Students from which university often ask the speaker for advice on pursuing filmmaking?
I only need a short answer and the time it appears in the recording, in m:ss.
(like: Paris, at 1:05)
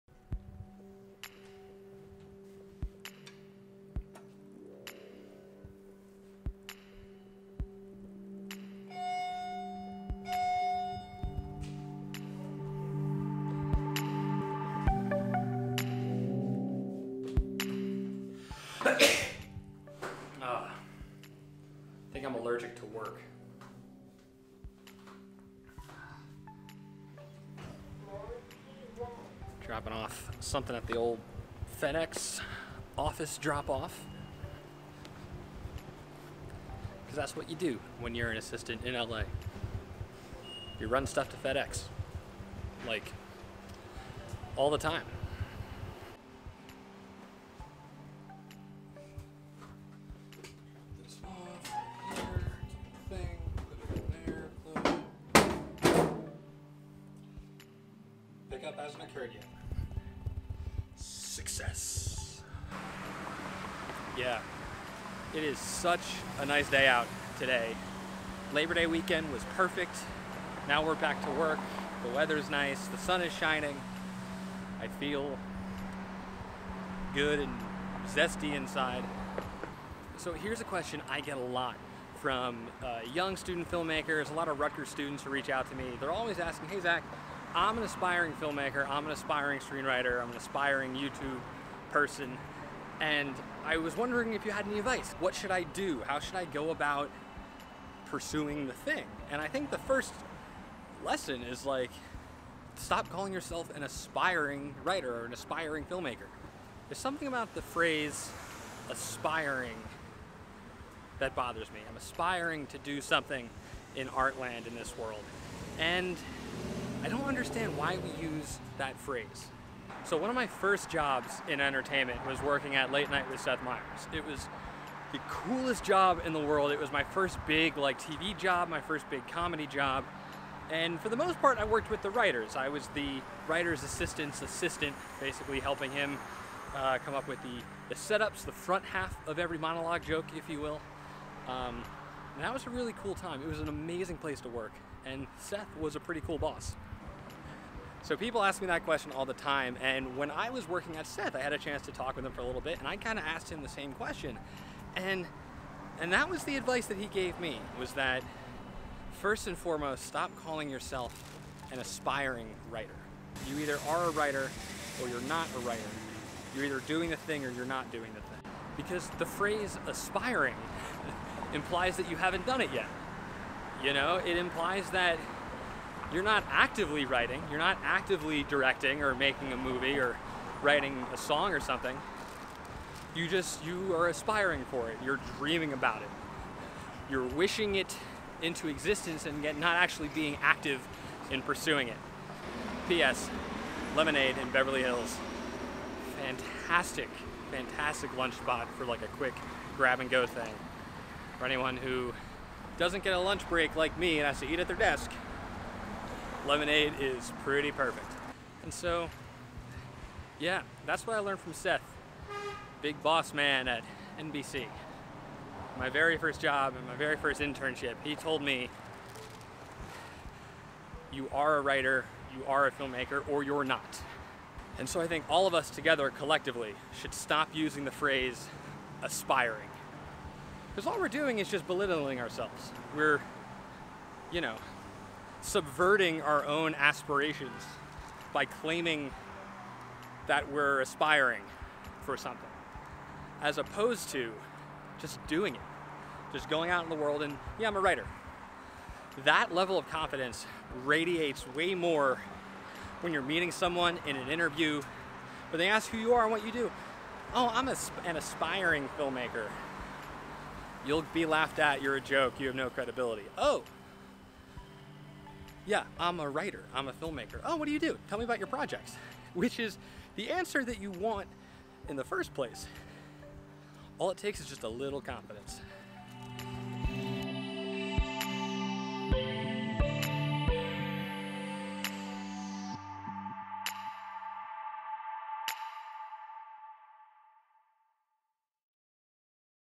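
Rutgers, at 1:24.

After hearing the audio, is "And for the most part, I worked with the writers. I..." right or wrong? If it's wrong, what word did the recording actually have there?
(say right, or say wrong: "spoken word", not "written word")
right.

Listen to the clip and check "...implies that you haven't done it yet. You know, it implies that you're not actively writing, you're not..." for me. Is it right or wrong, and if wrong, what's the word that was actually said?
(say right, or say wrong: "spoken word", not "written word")
right.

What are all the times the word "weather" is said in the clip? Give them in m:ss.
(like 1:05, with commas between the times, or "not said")
1:12.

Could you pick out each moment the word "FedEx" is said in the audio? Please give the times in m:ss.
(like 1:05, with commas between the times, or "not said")
0:31, 0:41.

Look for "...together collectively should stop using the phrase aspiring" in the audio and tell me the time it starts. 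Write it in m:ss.
3:45.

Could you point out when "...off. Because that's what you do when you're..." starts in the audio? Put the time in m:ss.
0:33.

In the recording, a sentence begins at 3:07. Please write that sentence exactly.
You're wishing it into existence and yet not actually being active in pursuing it.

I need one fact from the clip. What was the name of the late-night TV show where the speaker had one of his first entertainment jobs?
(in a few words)
Late Night with Seth Meyers.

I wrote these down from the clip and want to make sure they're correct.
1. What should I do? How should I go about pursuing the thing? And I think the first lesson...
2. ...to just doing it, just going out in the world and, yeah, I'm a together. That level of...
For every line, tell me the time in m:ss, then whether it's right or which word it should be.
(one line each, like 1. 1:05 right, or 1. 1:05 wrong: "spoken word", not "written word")
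1. 1:35 right
2. 4:04 wrong: "writer", not "together".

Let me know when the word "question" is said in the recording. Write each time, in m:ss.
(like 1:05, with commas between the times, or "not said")
1:20, 2:28, 2:33.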